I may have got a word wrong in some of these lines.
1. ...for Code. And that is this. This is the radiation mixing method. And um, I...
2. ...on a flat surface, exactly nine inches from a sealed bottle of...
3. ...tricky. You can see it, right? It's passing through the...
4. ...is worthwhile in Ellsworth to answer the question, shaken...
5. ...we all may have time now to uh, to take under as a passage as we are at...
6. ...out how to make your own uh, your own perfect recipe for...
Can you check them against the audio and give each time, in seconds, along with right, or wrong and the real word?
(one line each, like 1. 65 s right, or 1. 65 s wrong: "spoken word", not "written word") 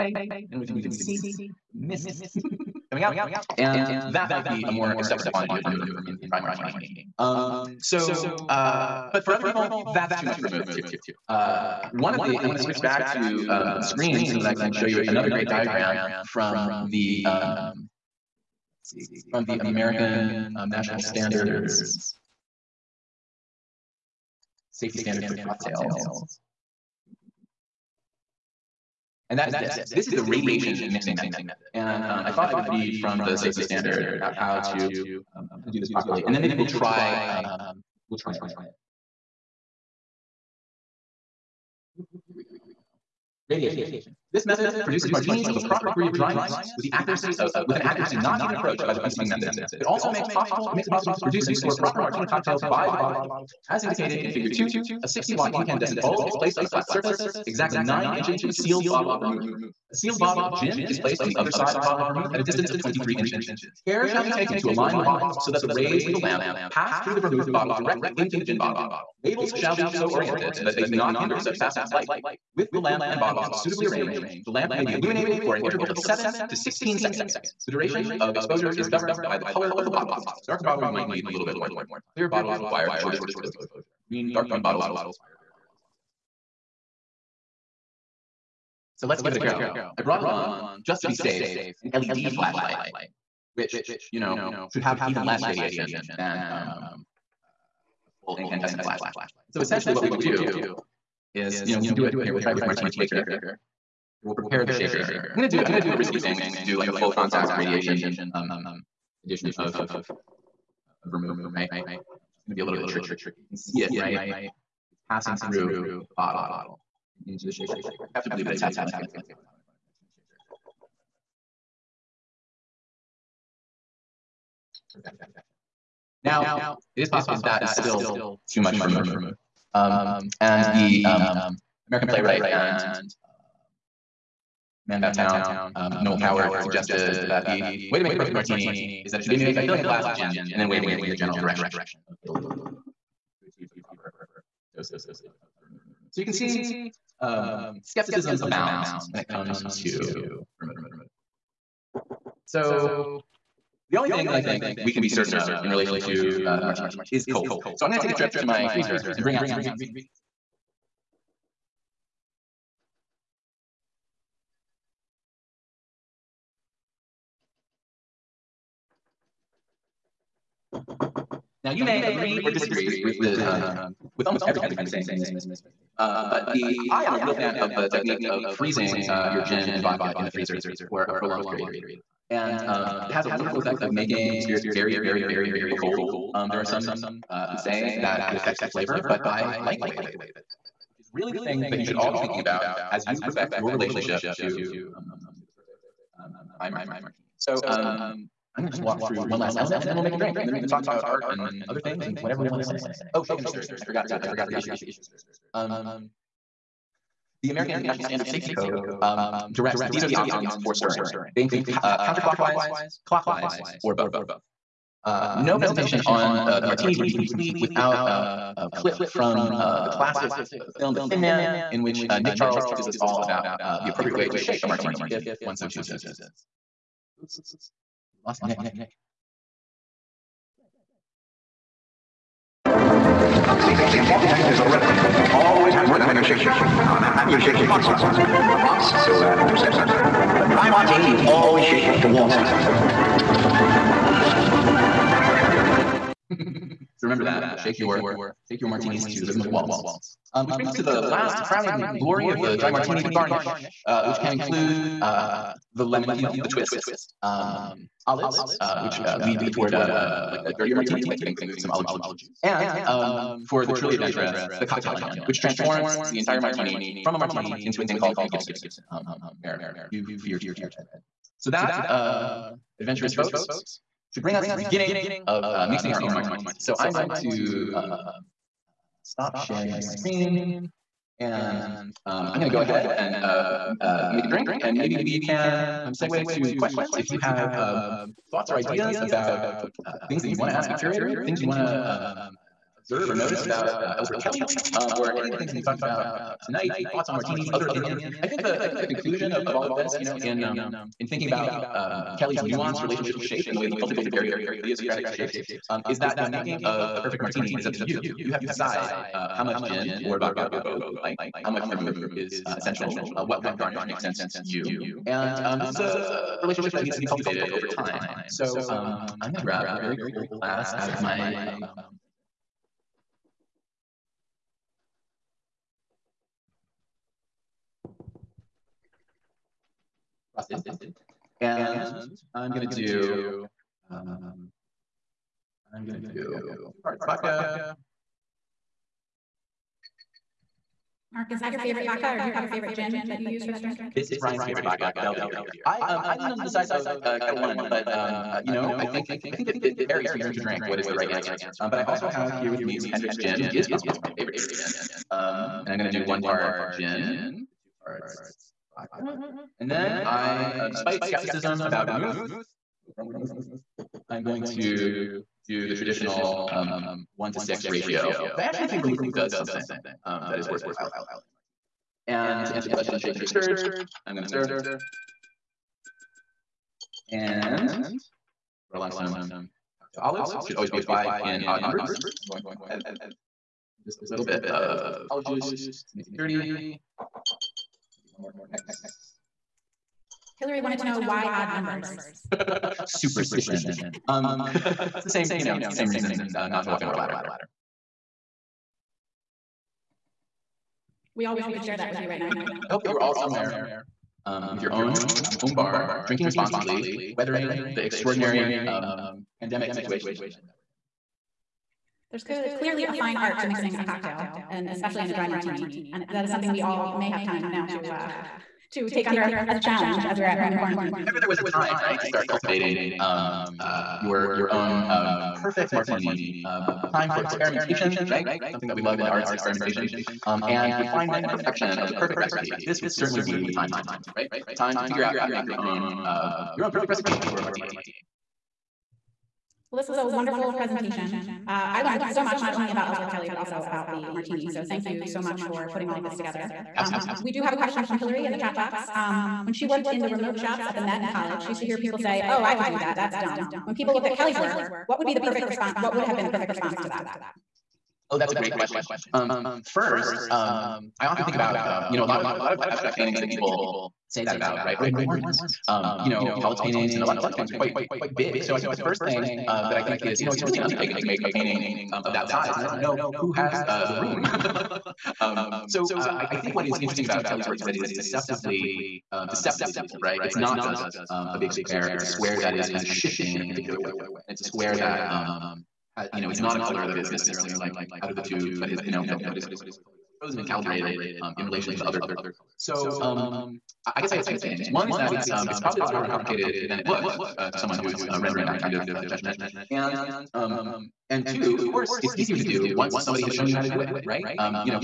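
1. 25 s wrong: "Cocktails", not "Code"
2. 56 s right
3. 112 s right
4. 370 s wrong: "And", not "Ellsworth"
5. 416 s wrong: "challenge", not "passage"
6. 435 s right.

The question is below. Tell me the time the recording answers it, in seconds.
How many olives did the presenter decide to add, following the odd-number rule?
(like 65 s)
382 s.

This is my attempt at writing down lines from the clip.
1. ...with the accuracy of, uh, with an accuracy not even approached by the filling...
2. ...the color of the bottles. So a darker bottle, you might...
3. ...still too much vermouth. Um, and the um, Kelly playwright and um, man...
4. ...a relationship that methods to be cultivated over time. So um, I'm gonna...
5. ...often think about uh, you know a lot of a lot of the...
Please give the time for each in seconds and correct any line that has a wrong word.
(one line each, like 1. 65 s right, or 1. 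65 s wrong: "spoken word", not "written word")
1. 46 s wrong: "preceding", not "filling"
2. 79 s right
3. 127 s wrong: "American", not "Kelly"
4. 315 s wrong: "needs", not "methods"
5. 461 s right.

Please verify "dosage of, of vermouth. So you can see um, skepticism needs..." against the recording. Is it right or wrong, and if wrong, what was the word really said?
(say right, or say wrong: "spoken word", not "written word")
wrong: "abounds", not "needs".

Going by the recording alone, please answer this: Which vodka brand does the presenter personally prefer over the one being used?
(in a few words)
Ketel One.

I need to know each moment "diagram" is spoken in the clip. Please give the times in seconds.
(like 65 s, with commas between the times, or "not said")
15 s.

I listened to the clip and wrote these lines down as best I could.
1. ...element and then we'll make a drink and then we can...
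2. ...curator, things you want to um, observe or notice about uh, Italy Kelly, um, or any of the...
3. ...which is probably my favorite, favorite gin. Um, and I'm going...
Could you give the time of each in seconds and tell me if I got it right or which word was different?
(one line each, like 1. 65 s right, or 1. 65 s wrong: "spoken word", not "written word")
1. 199 s right
2. 290 s wrong: "Ellsworth", not "Italy"
3. 353 s right.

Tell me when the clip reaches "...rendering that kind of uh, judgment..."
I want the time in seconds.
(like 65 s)
498 s.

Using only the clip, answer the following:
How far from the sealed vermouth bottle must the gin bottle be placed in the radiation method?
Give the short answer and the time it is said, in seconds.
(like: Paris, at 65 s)
23 inches, at 62 s.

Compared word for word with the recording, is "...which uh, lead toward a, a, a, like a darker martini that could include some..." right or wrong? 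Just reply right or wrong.
wrong.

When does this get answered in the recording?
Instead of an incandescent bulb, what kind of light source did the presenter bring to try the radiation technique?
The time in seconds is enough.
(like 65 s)
91 s.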